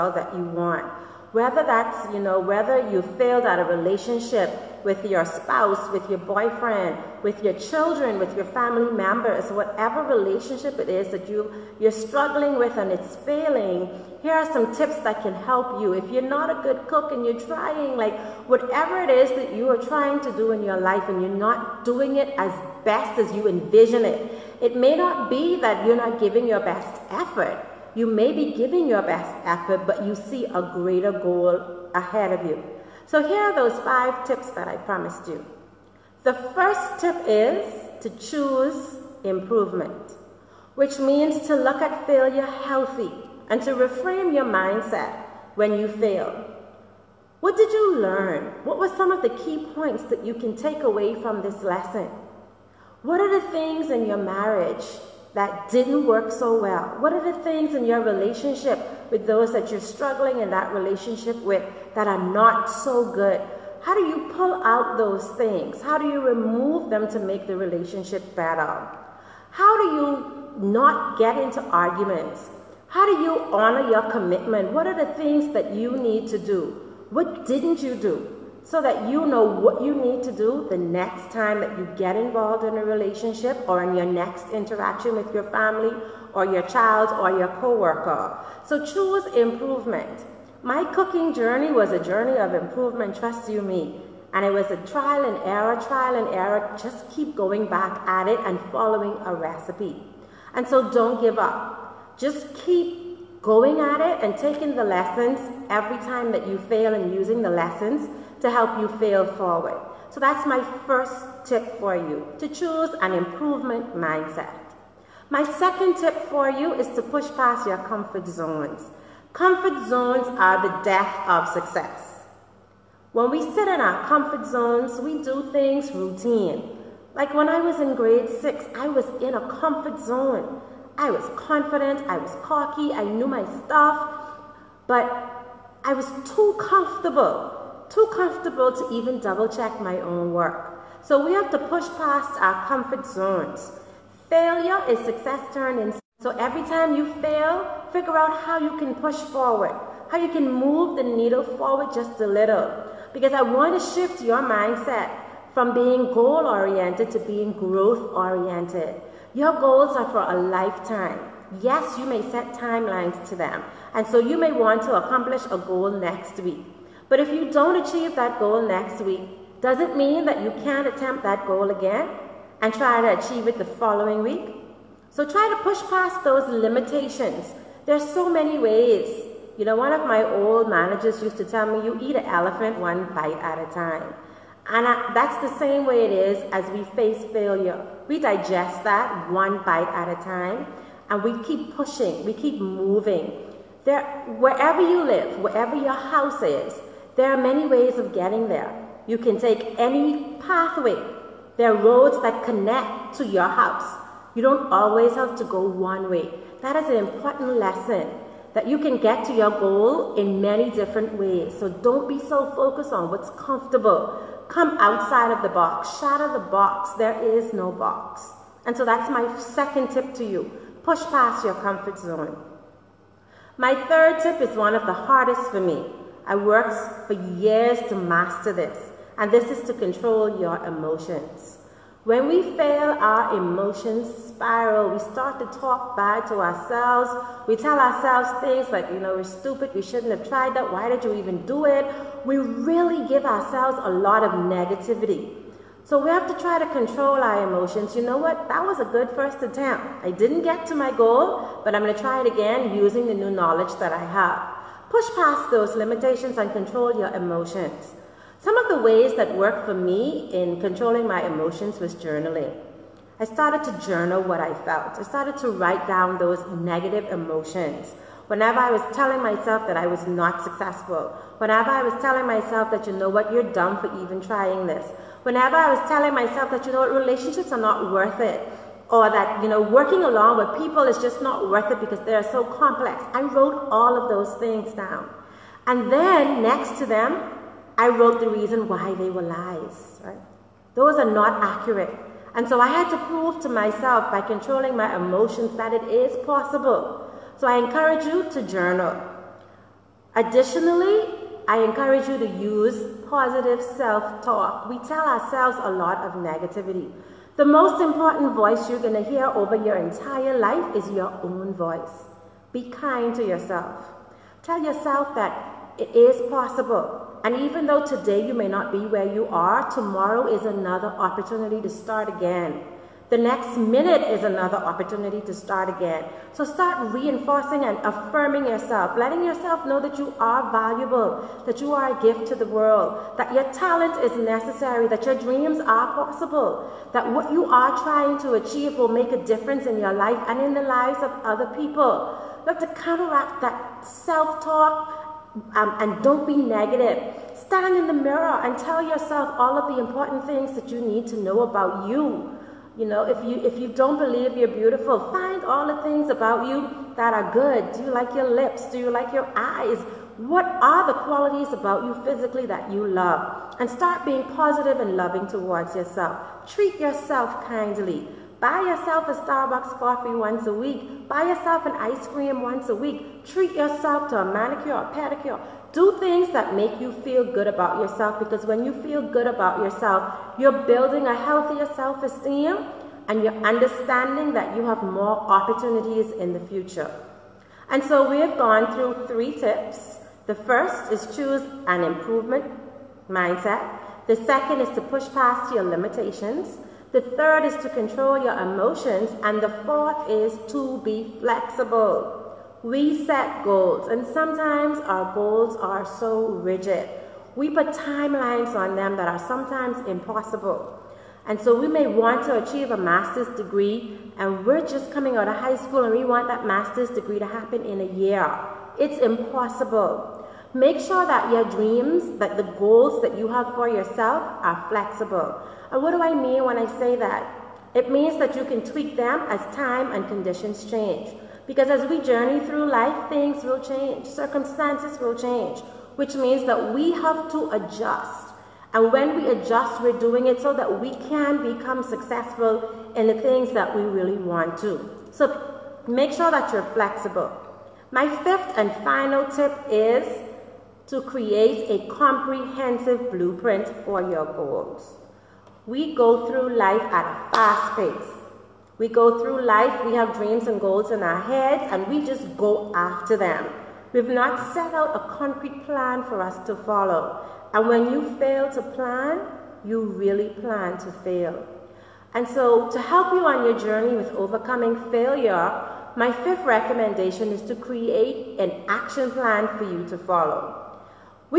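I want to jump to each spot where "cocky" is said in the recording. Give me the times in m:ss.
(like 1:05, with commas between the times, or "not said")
2:12.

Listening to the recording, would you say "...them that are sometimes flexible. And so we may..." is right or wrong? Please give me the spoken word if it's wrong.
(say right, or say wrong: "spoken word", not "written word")
wrong: "impossible", not "flexible".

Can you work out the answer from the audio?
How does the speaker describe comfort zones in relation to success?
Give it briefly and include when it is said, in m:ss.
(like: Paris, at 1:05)
the death of success, at 2:00.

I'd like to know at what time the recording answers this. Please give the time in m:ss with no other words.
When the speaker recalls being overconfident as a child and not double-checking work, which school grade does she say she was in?
2:07.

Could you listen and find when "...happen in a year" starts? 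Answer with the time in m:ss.
6:57.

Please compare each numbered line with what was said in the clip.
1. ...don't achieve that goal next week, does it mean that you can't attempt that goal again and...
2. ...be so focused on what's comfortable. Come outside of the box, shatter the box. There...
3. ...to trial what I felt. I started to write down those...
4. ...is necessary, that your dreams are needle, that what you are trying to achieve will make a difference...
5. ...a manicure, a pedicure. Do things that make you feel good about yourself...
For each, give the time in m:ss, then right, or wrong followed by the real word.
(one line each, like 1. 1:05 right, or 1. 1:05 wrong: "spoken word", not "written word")
1. 2:47 right
2. 3:32 right
3. 4:23 wrong: "journal", not "trial"
4. 5:34 wrong: "possible", not "needle"
5. 6:14 right.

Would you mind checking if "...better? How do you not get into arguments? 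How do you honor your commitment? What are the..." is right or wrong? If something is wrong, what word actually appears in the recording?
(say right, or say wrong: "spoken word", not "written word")
right.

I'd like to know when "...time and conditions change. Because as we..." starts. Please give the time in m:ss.
7:09.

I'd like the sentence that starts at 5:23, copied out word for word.
The next minute is another opportunity to start again.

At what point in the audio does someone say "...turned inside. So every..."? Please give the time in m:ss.
2:25.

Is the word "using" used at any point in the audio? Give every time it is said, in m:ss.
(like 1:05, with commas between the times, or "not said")
1:47, 4:12.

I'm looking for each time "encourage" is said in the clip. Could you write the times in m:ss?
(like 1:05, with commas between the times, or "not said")
4:57, 5:01.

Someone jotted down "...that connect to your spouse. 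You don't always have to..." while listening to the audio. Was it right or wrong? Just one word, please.
wrong.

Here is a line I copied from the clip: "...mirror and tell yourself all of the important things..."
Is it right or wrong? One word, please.
right.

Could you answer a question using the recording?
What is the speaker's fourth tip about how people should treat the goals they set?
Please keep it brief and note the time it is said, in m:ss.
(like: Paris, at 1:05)
be flexible, at 6:40.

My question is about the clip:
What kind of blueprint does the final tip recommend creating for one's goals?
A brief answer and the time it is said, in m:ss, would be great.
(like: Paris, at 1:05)
comprehensive, at 7:31.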